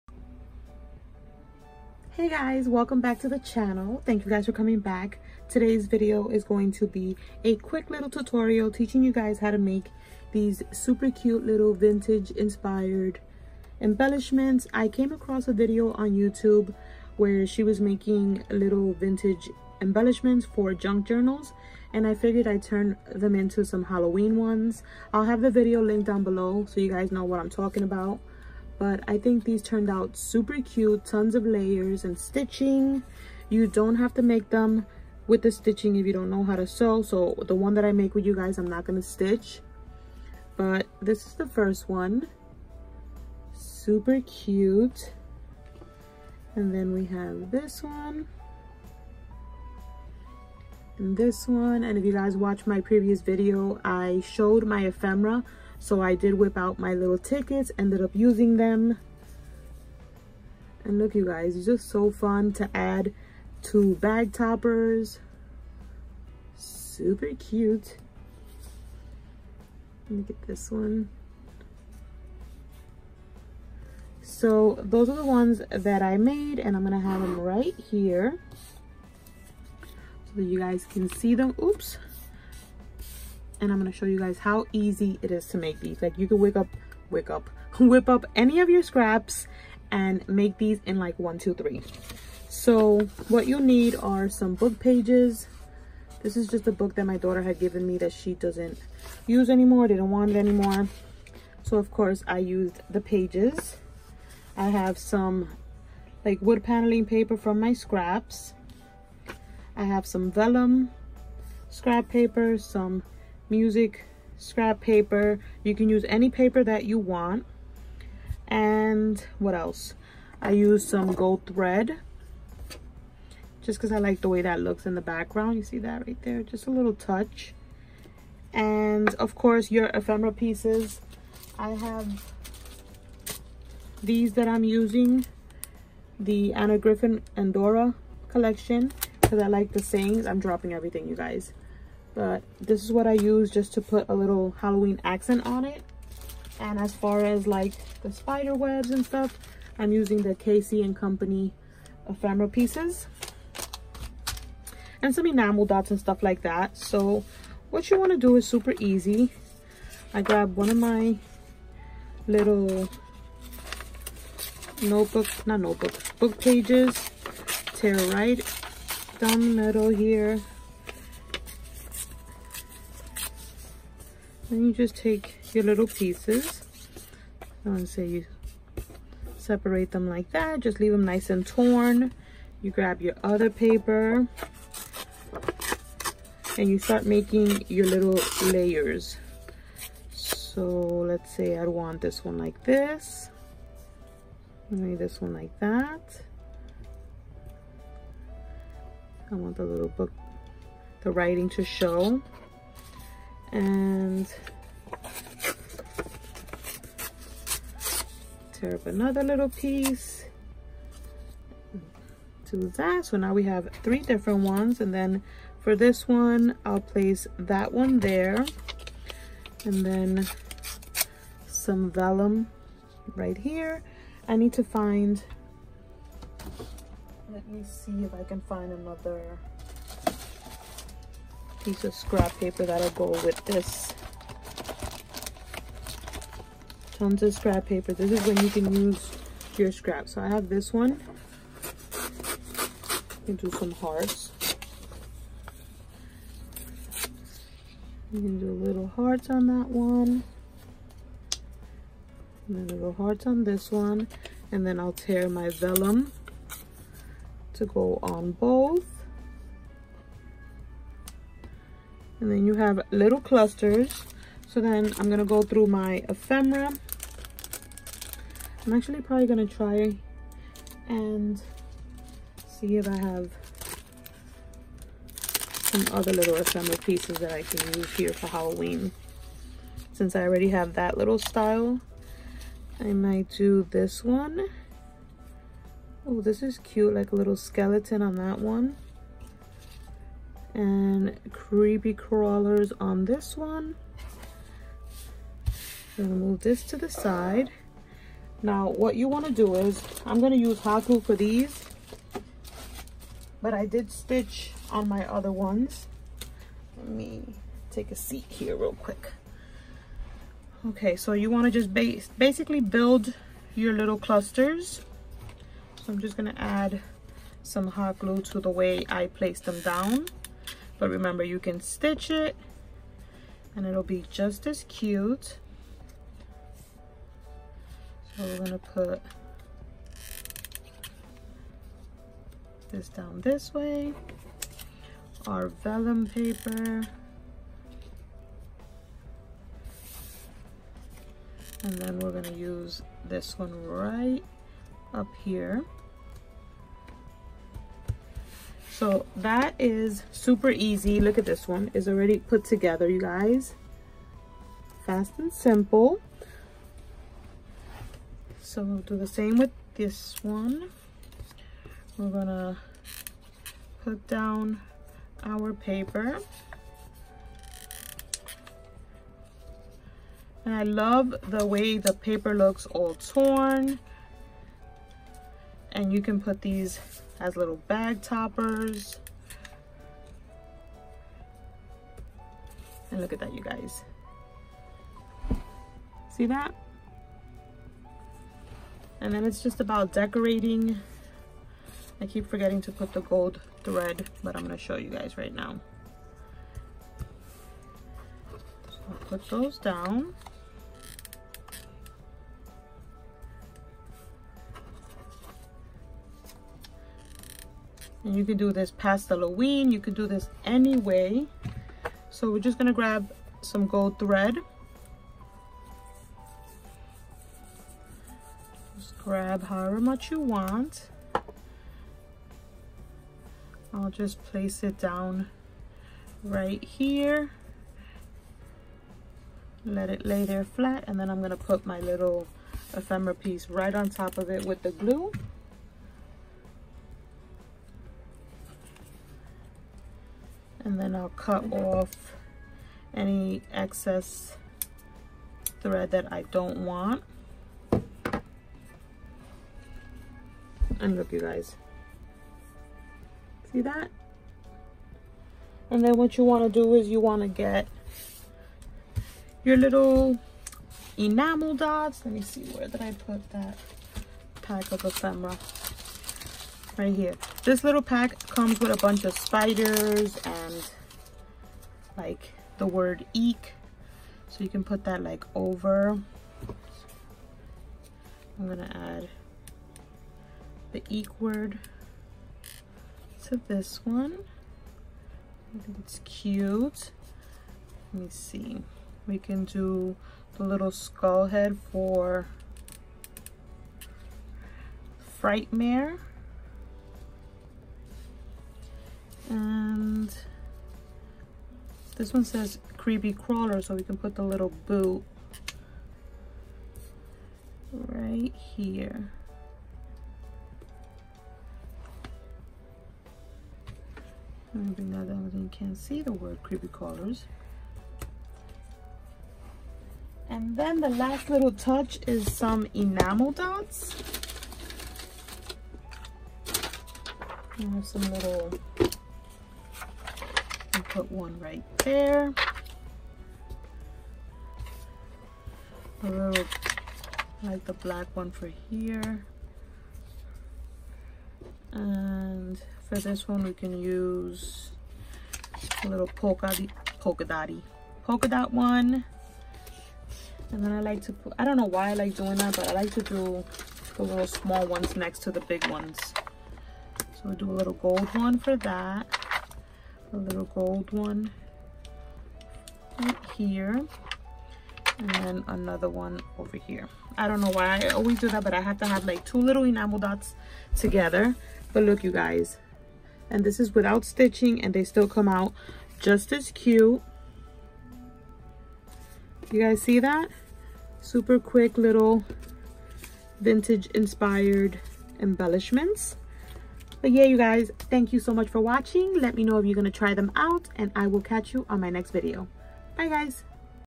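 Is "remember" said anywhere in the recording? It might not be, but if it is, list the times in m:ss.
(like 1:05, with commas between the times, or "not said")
5:20.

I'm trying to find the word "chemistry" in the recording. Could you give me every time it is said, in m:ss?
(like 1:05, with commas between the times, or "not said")
not said.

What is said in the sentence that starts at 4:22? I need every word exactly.
And then you have little clusters.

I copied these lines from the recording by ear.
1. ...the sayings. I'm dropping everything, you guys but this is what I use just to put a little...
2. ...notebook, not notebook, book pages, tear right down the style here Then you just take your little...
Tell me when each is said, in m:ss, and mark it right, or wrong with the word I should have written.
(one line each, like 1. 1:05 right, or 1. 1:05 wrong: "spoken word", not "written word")
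1. 2:19 right
2. 2:44 wrong: "middle", not "style".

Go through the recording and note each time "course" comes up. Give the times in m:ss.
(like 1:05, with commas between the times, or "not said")
1:41, 2:09.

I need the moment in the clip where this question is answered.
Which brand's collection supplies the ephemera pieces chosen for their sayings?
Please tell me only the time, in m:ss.
2:16.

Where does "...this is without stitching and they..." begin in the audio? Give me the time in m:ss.
9:33.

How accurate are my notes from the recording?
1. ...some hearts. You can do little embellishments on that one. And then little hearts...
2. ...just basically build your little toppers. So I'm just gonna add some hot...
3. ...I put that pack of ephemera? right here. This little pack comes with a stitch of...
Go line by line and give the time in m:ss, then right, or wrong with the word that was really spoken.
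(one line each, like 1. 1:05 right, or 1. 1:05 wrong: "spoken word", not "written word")
1. 4:03 wrong: "hearts", not "embellishments"
2. 5:11 wrong: "clusters", not "toppers"
3. 7:42 wrong: "bunch", not "stitch".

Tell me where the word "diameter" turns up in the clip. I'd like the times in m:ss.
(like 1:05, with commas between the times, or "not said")
not said.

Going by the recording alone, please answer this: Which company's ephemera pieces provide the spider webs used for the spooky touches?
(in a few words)
Casey and Company.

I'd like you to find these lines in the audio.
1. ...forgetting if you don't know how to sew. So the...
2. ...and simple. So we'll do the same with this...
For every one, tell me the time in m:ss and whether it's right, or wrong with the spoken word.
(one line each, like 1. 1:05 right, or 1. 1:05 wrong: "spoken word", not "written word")
1. 0:35 wrong: "stitching", not "forgetting"
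2. 5:55 right.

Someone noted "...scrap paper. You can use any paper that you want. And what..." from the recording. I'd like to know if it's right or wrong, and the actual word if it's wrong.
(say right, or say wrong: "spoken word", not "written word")
right.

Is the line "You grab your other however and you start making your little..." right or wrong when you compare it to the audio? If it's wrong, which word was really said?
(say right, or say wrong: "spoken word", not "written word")
wrong: "paper", not "however".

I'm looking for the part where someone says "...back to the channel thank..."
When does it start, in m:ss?
0:02.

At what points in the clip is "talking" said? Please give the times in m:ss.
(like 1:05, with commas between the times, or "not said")
0:27.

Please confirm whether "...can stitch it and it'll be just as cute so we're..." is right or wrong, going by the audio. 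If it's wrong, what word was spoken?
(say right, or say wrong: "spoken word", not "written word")
right.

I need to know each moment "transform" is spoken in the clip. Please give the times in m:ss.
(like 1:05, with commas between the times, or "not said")
not said.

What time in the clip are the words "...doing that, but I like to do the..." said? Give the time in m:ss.
9:12.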